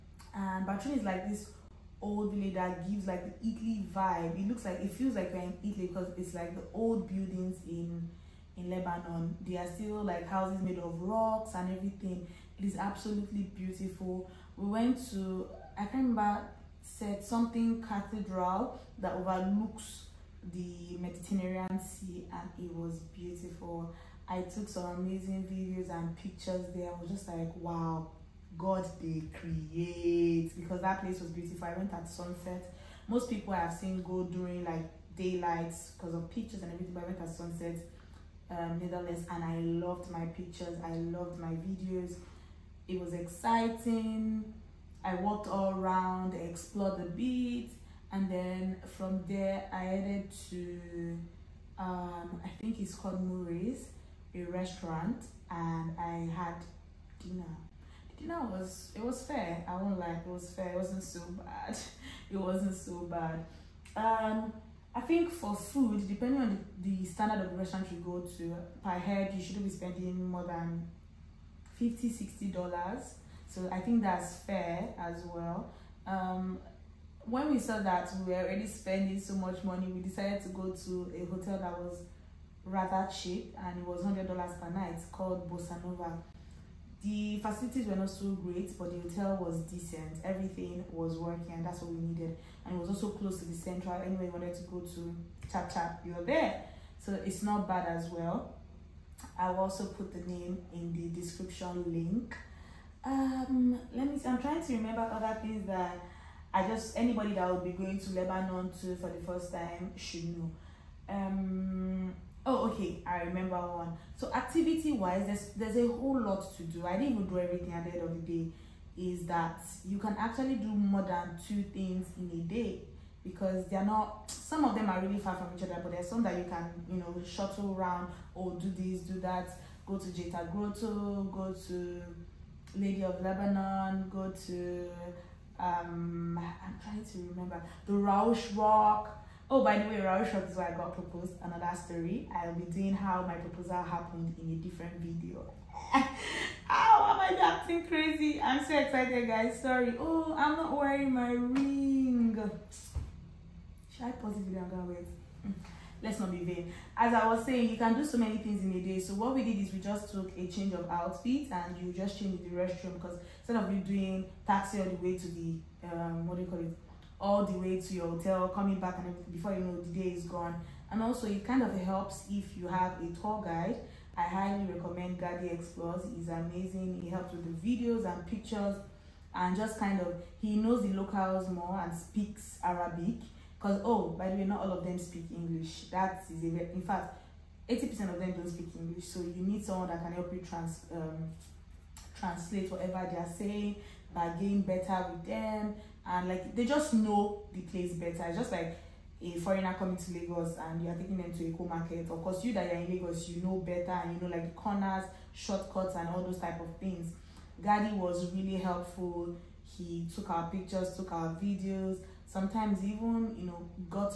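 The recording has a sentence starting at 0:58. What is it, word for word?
The dinner was, it was fair.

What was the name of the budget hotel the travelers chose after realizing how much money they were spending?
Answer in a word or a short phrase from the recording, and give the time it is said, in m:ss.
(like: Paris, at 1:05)
Bossanova, at 1:25.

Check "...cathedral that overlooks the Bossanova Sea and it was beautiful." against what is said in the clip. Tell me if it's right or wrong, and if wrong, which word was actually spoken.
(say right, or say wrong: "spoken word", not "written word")
wrong: "Mediterranean", not "Bossanova".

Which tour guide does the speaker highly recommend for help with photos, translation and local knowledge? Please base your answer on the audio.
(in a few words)
Ghady Explores.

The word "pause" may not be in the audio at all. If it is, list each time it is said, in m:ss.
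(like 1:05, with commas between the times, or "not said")
2:34.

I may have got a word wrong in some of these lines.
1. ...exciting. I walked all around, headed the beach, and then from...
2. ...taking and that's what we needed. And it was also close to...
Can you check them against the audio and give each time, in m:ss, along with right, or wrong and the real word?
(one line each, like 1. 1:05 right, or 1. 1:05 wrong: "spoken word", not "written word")
1. 0:43 wrong: "explored", not "headed"
2. 1:31 wrong: "working", not "taking".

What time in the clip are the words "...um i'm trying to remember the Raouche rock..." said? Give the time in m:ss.
2:15.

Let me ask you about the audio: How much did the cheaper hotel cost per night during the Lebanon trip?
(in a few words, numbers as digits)
$100.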